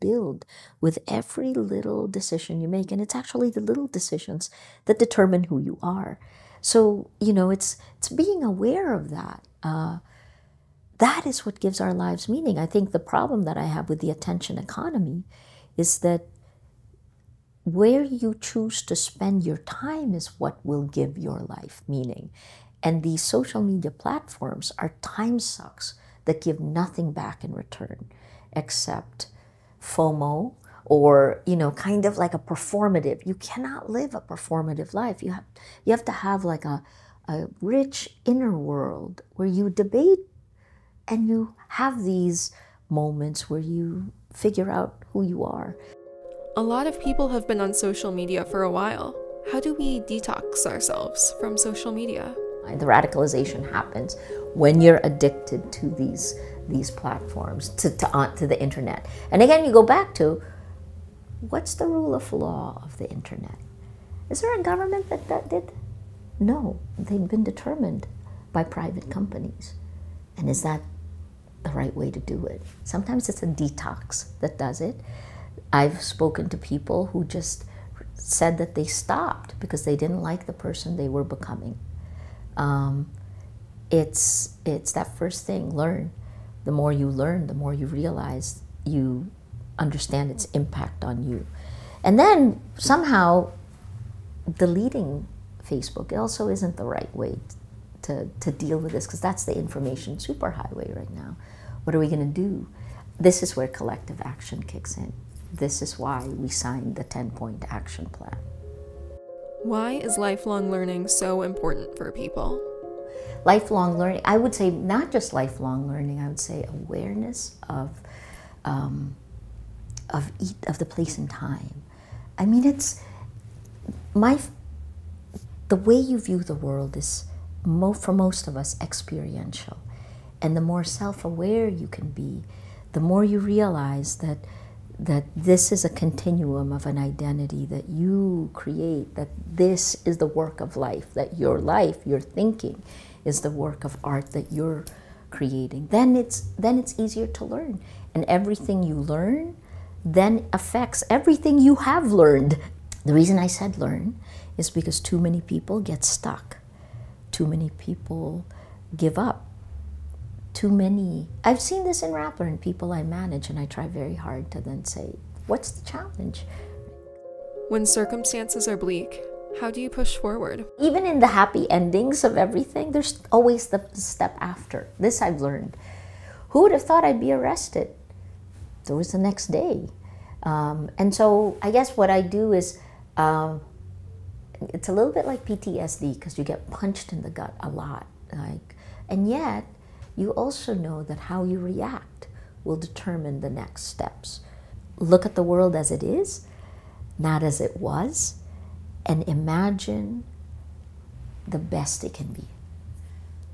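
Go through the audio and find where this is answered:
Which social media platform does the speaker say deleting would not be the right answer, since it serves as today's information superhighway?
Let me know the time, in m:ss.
1:35.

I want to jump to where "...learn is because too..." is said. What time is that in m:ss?
2:33.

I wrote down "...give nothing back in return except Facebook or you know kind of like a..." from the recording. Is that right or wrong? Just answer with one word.
wrong.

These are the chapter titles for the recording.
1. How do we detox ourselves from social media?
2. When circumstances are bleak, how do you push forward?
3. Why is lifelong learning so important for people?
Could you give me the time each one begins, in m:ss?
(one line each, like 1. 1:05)
1. 0:45
2. 2:47
3. 1:49.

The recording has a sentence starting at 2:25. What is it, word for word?
Then it's then it's easier to learn.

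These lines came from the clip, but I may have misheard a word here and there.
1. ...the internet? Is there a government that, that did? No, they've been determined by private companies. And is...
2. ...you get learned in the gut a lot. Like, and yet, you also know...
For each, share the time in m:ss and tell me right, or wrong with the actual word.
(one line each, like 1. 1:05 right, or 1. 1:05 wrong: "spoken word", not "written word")
1. 1:02 right
2. 3:06 wrong: "punched", not "learned".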